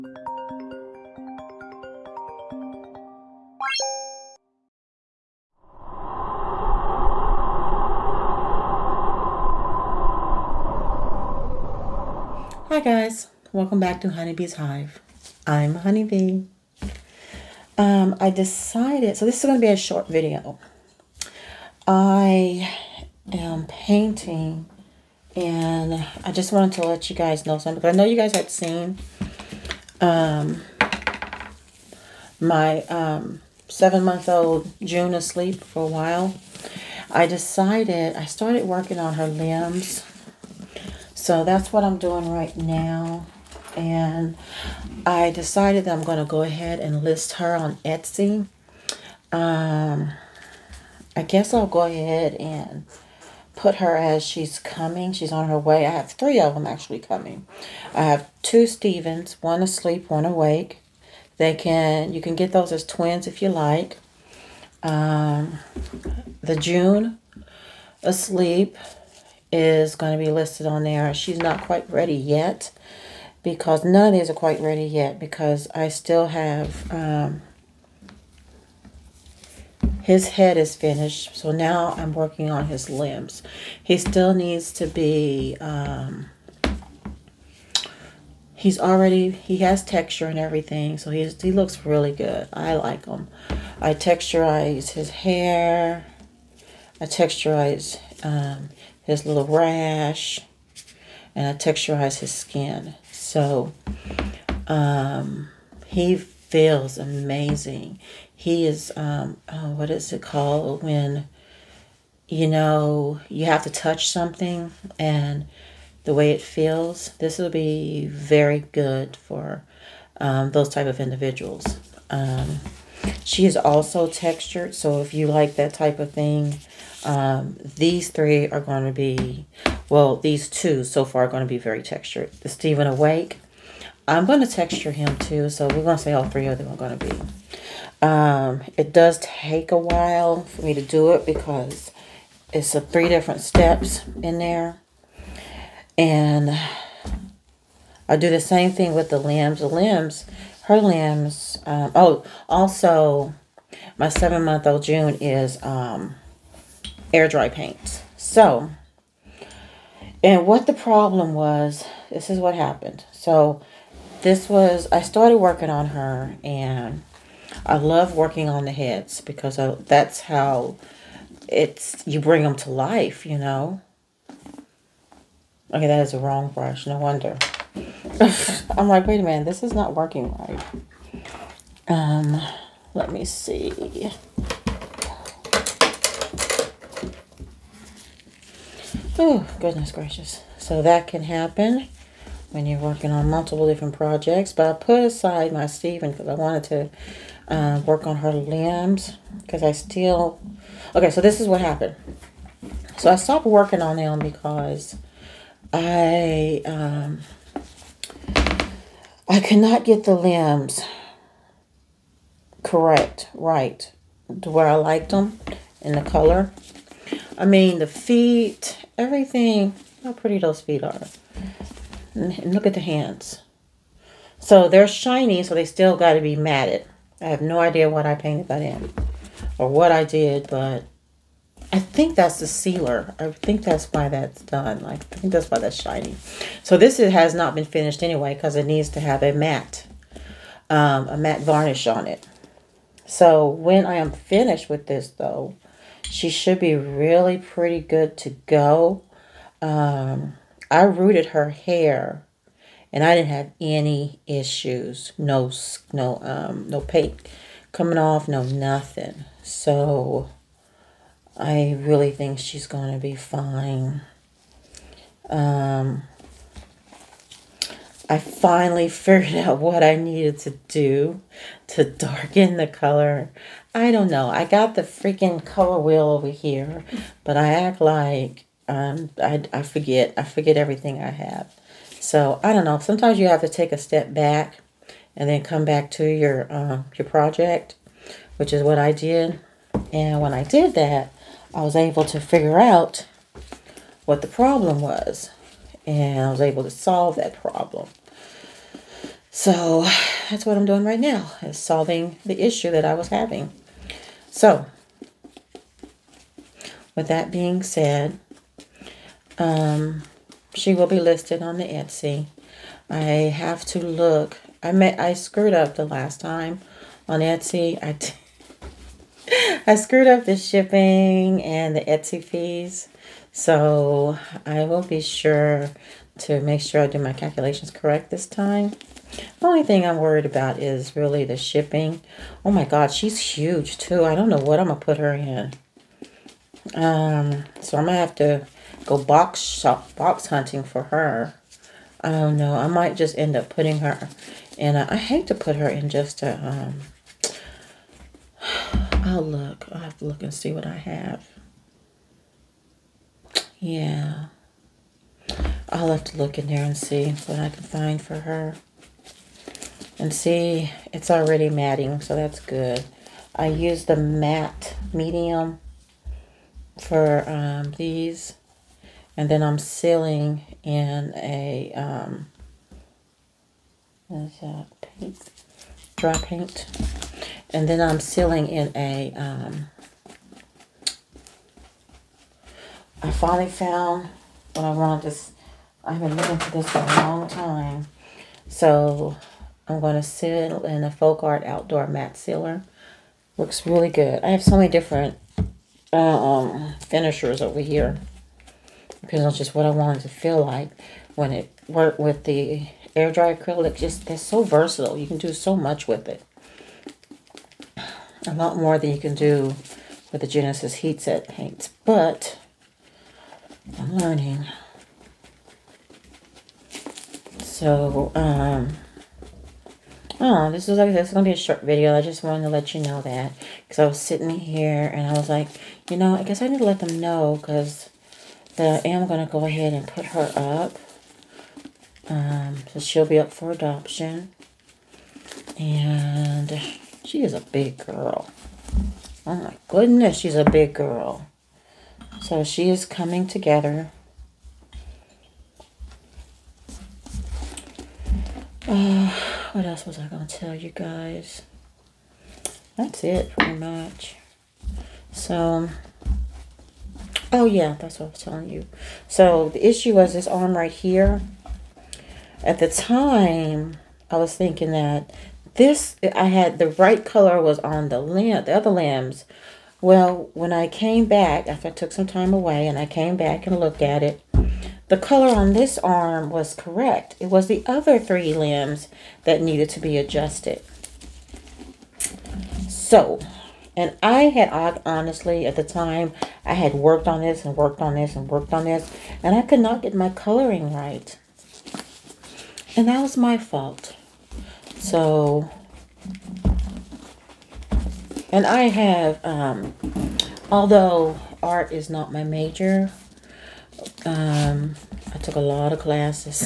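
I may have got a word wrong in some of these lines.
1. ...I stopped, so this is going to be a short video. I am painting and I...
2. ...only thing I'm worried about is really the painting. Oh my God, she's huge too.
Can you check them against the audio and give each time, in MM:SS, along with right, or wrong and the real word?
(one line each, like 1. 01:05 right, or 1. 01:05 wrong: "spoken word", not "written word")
1. 00:18 wrong: "decided", not "stopped"
2. 05:29 wrong: "shipping", not "painting".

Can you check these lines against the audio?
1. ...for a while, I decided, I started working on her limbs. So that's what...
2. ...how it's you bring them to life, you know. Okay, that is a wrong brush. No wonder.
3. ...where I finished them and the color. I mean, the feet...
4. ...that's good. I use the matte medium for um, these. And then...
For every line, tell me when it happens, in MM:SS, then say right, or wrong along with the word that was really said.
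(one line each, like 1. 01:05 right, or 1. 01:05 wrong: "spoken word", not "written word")
1. 00:35 right
2. 02:50 right
3. 03:34 wrong: "liked", not "finished"
4. 06:02 right.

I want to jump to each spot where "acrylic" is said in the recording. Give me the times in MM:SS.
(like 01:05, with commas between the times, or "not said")
06:43.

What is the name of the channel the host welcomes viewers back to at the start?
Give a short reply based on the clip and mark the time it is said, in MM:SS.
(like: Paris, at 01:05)
Honeybee's Hive, at 00:14.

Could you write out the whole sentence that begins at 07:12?
Um, so she'll be up for adoption.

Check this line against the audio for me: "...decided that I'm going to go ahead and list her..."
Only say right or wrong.
right.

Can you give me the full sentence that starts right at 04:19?
So I really think she's going to be fine.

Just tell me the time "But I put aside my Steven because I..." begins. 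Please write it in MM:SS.
03:14.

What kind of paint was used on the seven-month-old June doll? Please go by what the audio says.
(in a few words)
Air dry paint.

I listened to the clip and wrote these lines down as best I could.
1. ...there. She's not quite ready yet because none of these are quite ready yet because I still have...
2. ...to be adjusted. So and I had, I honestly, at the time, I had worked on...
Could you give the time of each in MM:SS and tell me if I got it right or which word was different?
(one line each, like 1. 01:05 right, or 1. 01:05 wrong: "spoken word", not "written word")
1. 01:10 right
2. 07:59 right.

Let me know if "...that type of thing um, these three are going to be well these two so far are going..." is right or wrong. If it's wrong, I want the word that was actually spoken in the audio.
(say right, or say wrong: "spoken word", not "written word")
right.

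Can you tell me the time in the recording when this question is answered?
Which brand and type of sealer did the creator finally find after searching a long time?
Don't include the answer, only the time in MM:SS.
06:30.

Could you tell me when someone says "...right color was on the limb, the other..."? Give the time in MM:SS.
07:46.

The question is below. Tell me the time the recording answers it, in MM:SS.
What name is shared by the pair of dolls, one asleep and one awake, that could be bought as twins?
00:58.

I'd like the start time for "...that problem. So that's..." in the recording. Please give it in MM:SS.
04:57.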